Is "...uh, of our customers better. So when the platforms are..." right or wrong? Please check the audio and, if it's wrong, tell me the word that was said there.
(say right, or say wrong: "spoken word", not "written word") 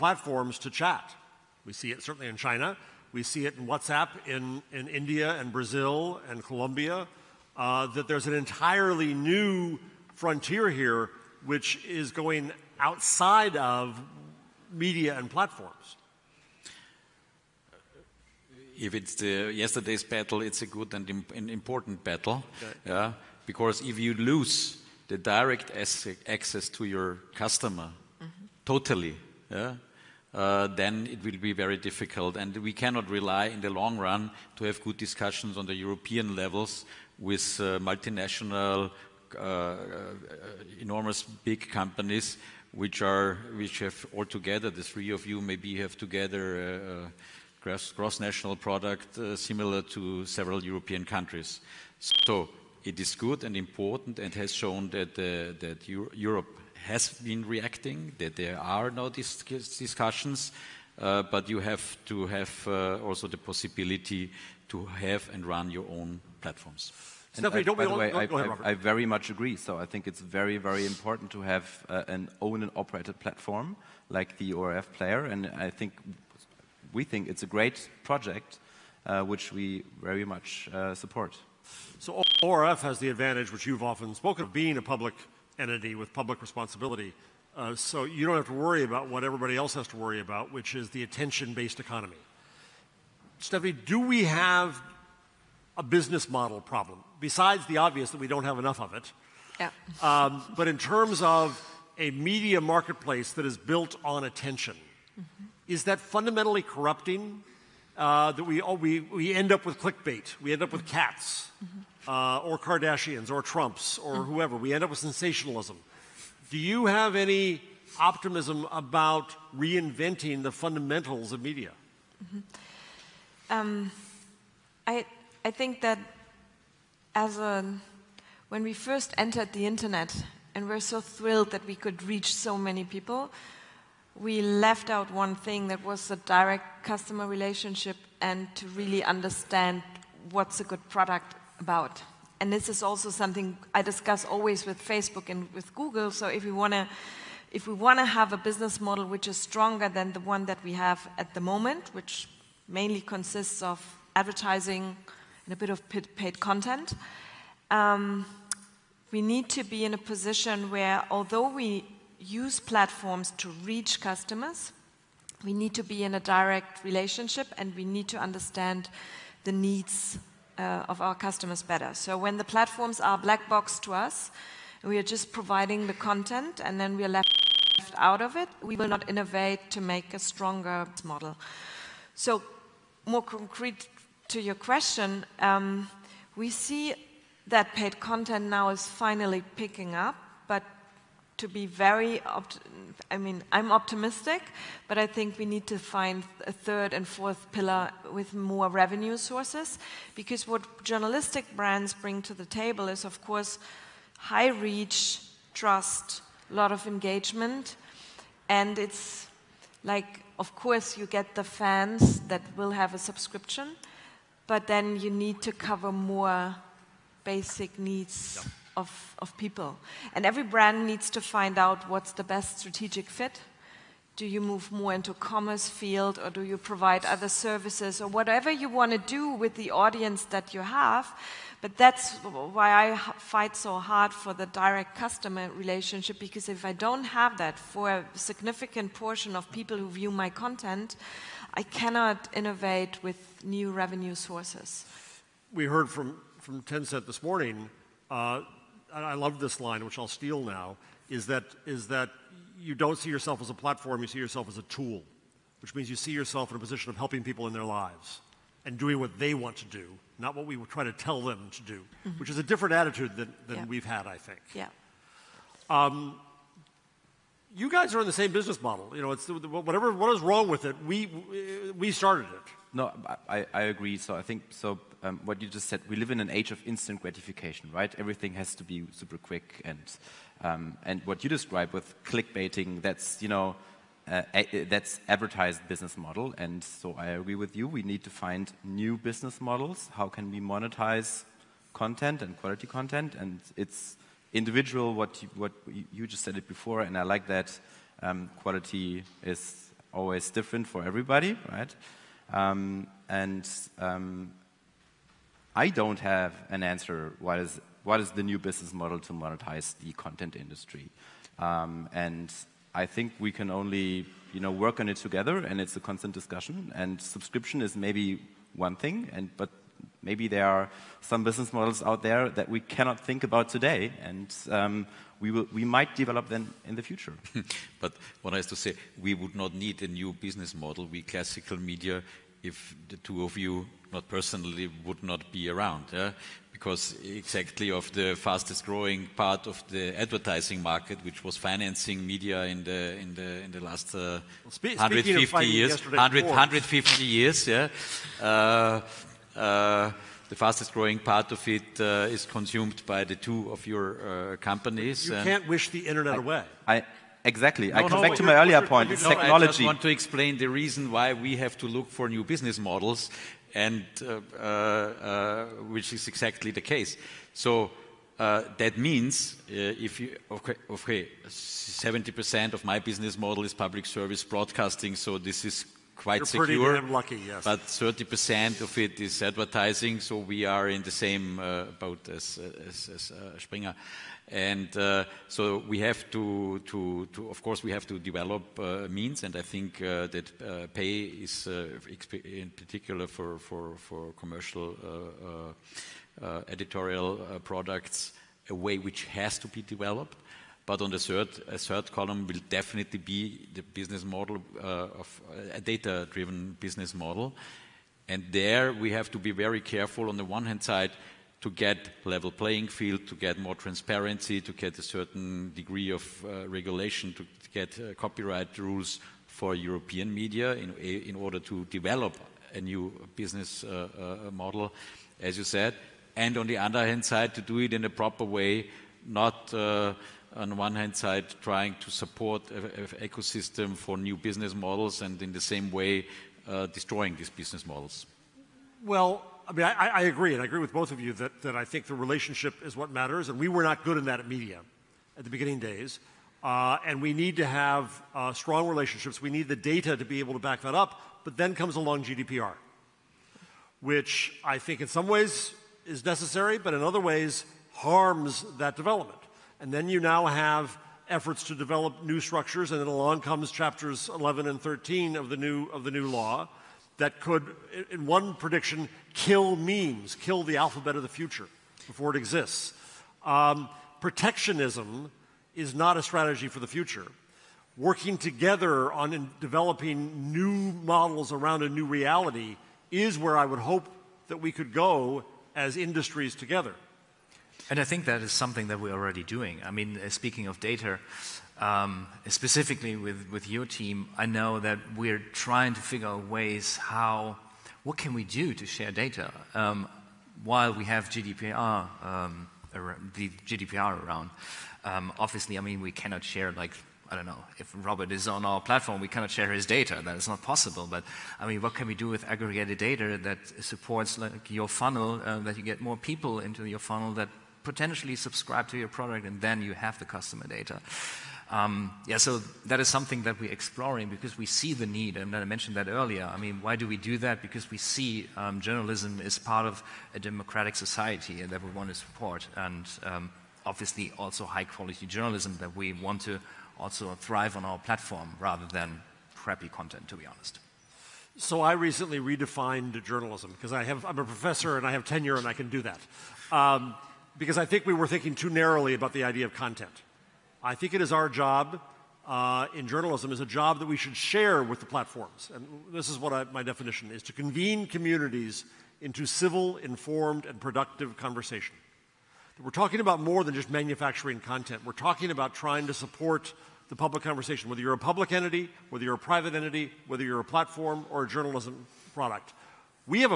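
right.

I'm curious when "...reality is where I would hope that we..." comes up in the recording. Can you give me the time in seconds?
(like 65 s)
481 s.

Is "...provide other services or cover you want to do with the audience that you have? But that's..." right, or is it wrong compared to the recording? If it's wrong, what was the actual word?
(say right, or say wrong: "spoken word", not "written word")
wrong: "whatever", not "cover".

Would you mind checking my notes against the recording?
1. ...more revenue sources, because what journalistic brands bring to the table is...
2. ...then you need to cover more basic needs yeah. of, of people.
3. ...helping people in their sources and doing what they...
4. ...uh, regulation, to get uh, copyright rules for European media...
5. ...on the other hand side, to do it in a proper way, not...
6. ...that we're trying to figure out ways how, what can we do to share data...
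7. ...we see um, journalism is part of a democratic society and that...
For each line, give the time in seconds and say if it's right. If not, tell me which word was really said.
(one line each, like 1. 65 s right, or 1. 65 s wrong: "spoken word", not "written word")
1. 198 s right
2. 214 s right
3. 256 s wrong: "lives", not "sources"
4. 416 s right
5. 426 s right
6. 494 s right
7. 527 s right.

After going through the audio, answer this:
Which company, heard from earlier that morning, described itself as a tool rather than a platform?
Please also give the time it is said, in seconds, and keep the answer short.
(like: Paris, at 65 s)
Tencent, at 246 s.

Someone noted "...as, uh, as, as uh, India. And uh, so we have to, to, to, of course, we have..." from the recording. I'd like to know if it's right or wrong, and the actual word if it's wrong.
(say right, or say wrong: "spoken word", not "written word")
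wrong: "Springer", not "India".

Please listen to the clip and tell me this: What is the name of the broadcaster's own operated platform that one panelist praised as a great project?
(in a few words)
ORF player.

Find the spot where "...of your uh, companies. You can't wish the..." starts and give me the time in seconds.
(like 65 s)
353 s.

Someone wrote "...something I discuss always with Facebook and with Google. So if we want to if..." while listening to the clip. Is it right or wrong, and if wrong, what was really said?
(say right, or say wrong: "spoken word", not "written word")
right.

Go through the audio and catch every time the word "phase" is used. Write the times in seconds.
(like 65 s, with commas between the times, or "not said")
not said.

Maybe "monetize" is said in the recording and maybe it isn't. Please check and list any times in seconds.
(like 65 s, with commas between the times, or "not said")
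290 s, 309 s.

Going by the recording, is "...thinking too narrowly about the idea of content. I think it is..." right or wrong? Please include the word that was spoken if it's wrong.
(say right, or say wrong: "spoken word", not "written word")
right.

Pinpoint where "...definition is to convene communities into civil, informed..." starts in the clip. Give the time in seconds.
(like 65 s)
556 s.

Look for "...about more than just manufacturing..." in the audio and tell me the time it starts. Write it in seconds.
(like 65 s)
563 s.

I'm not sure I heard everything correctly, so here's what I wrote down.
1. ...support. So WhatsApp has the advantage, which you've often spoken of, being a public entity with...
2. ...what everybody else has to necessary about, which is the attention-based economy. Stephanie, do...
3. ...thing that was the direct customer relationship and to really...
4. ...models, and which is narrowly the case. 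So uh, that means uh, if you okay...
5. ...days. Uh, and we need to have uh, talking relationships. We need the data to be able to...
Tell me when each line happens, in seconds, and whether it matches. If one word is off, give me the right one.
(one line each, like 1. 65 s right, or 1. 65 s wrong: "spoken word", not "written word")
1. 80 s wrong: "ORF", not "WhatsApp"
2. 89 s wrong: "worry", not "necessary"
3. 135 s right
4. 362 s wrong: "exactly", not "narrowly"
5. 445 s wrong: "strong", not "talking".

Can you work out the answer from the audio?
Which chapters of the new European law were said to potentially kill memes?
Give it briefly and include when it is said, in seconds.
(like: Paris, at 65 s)
11 and 13, at 464 s.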